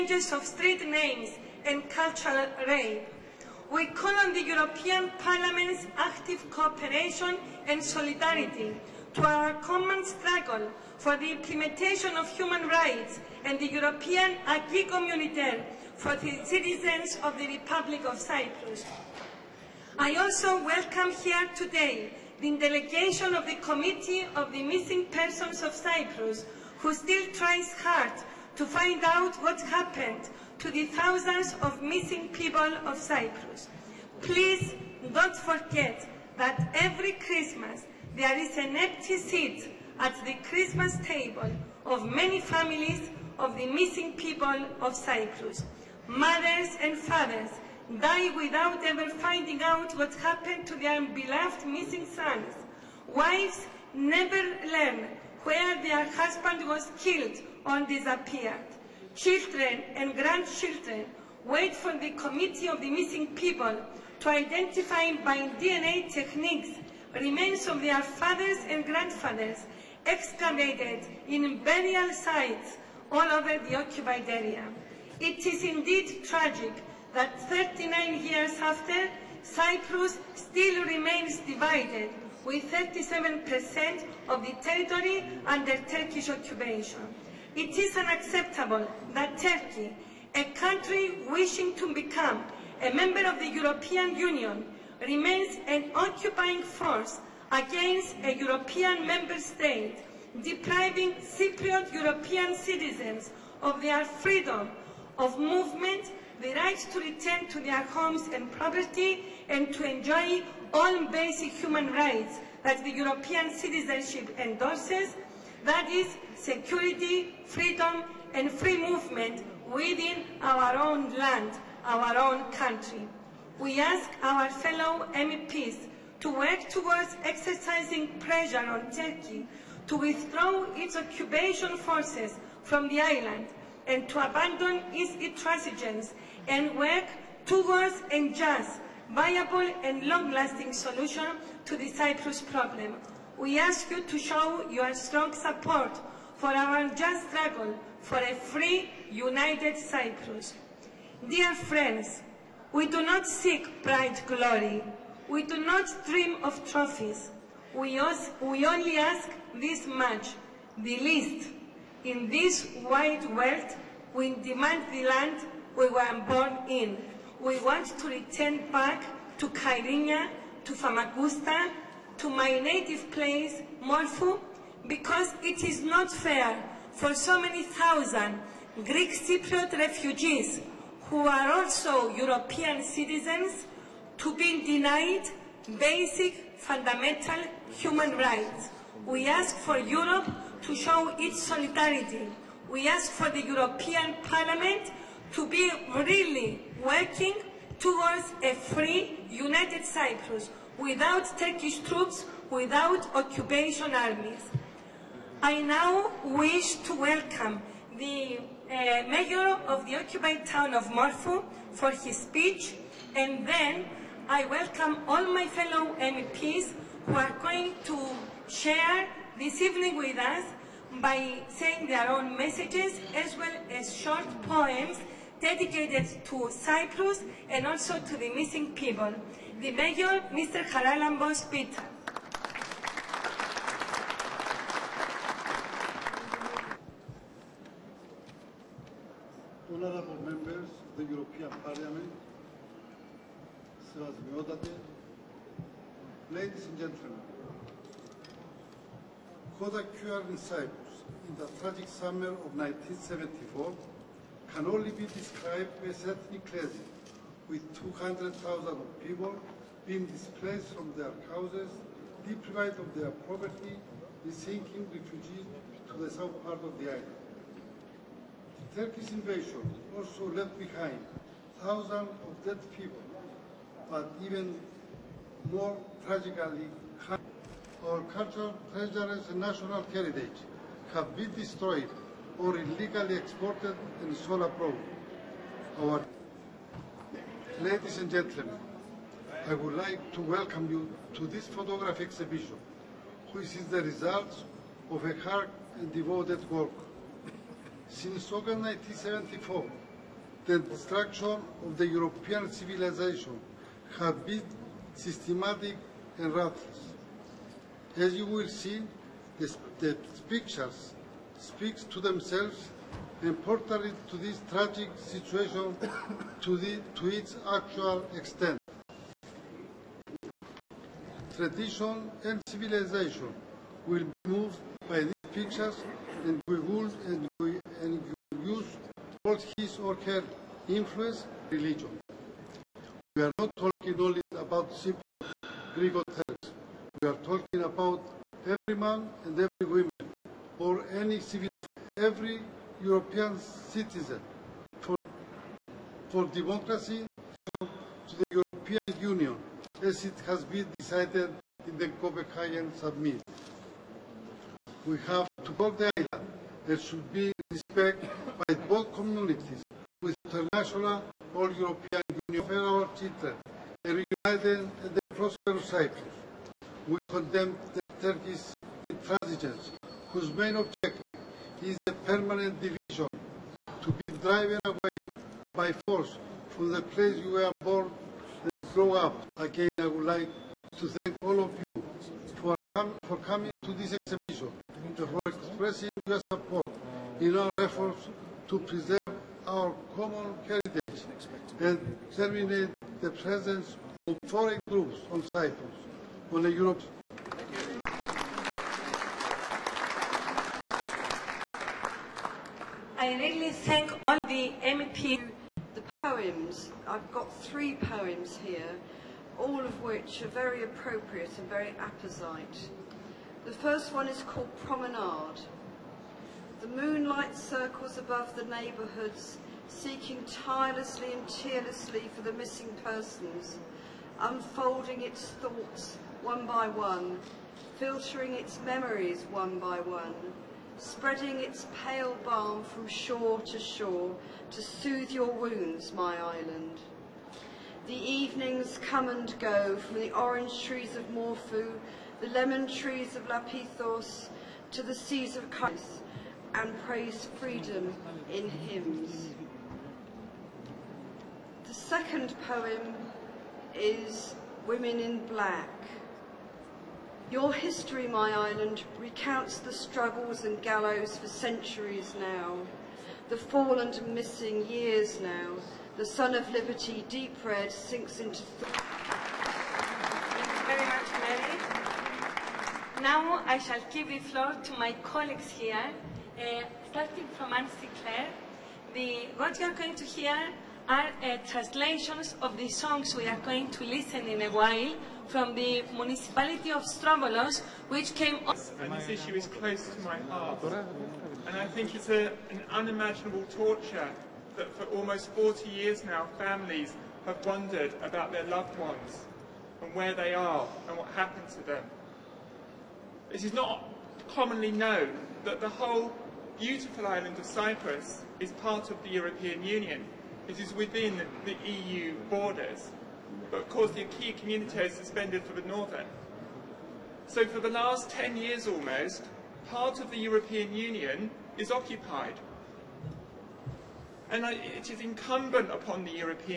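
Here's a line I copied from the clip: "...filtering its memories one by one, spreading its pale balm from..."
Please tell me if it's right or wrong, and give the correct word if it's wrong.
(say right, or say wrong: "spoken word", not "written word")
right.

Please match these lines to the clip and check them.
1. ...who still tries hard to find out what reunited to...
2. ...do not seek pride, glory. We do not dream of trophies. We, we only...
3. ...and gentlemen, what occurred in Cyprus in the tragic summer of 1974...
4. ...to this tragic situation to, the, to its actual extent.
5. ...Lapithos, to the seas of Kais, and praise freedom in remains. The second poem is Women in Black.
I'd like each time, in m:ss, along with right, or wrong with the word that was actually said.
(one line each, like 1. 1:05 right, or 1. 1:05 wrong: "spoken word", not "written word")
1. 0:26 wrong: "happened", not "reunited"
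2. 2:32 right
3. 4:06 right
4. 5:14 right
5. 7:23 wrong: "hymns", not "remains".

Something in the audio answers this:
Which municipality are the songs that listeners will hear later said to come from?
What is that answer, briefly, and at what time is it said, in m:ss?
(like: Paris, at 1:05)
Strovolos, at 8:06.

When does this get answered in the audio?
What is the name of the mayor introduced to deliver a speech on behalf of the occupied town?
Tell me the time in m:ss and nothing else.
3:50.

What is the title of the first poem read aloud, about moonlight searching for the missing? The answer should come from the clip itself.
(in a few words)
Promenade.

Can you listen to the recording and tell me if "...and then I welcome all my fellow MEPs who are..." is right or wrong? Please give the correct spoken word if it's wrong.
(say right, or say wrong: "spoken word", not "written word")
right.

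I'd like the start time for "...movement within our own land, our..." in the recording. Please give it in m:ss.
1:58.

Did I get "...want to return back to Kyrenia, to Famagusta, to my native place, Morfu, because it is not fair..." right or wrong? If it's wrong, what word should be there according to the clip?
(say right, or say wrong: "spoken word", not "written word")
right.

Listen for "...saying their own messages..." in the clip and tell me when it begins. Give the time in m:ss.
3:41.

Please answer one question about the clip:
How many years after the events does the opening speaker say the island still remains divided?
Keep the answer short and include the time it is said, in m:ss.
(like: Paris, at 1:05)
39, at 1:17.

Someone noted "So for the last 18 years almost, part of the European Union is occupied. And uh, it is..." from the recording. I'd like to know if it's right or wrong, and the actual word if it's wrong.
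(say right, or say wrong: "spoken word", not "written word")
wrong: "10", not "18".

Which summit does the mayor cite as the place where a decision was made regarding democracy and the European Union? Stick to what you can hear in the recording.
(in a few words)
Copenhagen Summit.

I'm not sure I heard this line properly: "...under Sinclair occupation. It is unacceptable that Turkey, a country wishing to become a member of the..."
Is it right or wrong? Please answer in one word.
wrong.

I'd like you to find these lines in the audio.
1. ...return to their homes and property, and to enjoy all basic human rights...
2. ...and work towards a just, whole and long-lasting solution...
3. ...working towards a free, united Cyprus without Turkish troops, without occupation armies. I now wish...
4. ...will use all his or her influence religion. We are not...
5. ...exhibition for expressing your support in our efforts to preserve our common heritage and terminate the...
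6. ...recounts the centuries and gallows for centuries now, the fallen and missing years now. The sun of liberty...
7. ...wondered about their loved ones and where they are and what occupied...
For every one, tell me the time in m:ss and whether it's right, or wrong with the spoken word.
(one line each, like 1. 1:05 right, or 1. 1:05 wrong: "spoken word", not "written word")
1. 1:47 right
2. 2:16 wrong: "viable", not "whole"
3. 3:16 right
4. 5:28 right
5. 6:23 right
6. 7:39 wrong: "struggles", not "centuries"
7. 8:17 wrong: "happened", not "occupied".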